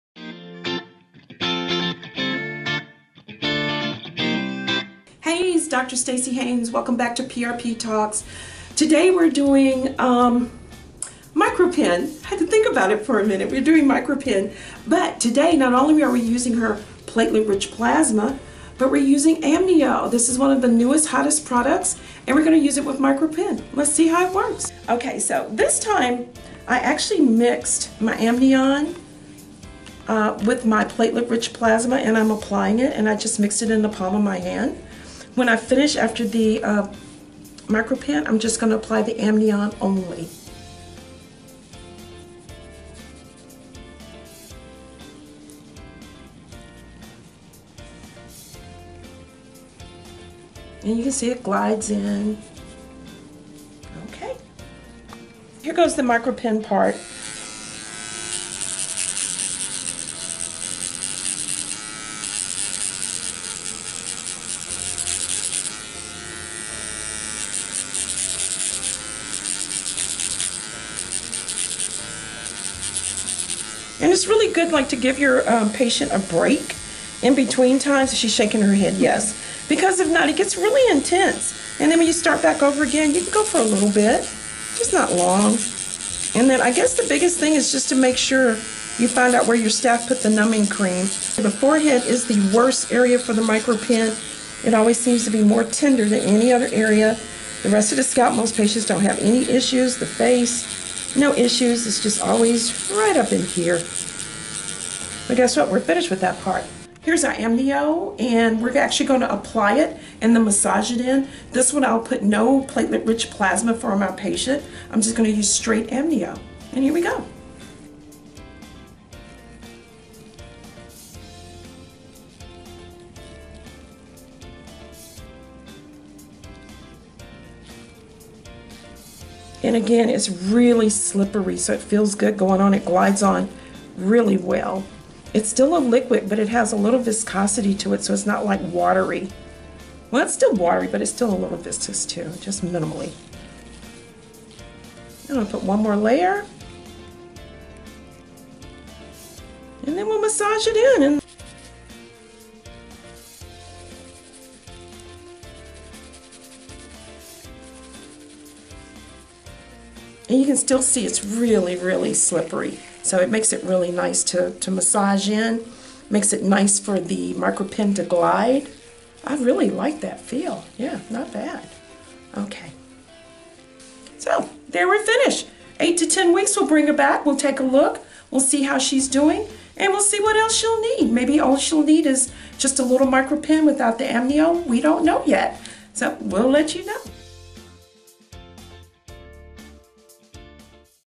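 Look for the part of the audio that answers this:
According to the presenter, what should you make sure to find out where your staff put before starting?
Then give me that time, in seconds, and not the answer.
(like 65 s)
90 s.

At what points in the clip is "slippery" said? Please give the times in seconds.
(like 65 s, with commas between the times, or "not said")
130 s, 162 s.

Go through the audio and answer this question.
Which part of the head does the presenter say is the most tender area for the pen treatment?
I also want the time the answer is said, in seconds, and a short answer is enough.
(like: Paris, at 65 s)
The forehead, at 91 s.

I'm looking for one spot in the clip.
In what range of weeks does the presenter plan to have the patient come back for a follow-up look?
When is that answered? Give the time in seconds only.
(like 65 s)
175 s.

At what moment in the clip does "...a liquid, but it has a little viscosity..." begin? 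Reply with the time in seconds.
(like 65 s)
135 s.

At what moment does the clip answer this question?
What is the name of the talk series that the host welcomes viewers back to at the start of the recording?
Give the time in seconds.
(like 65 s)
7 s.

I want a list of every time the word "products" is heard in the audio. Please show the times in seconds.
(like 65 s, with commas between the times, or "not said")
21 s.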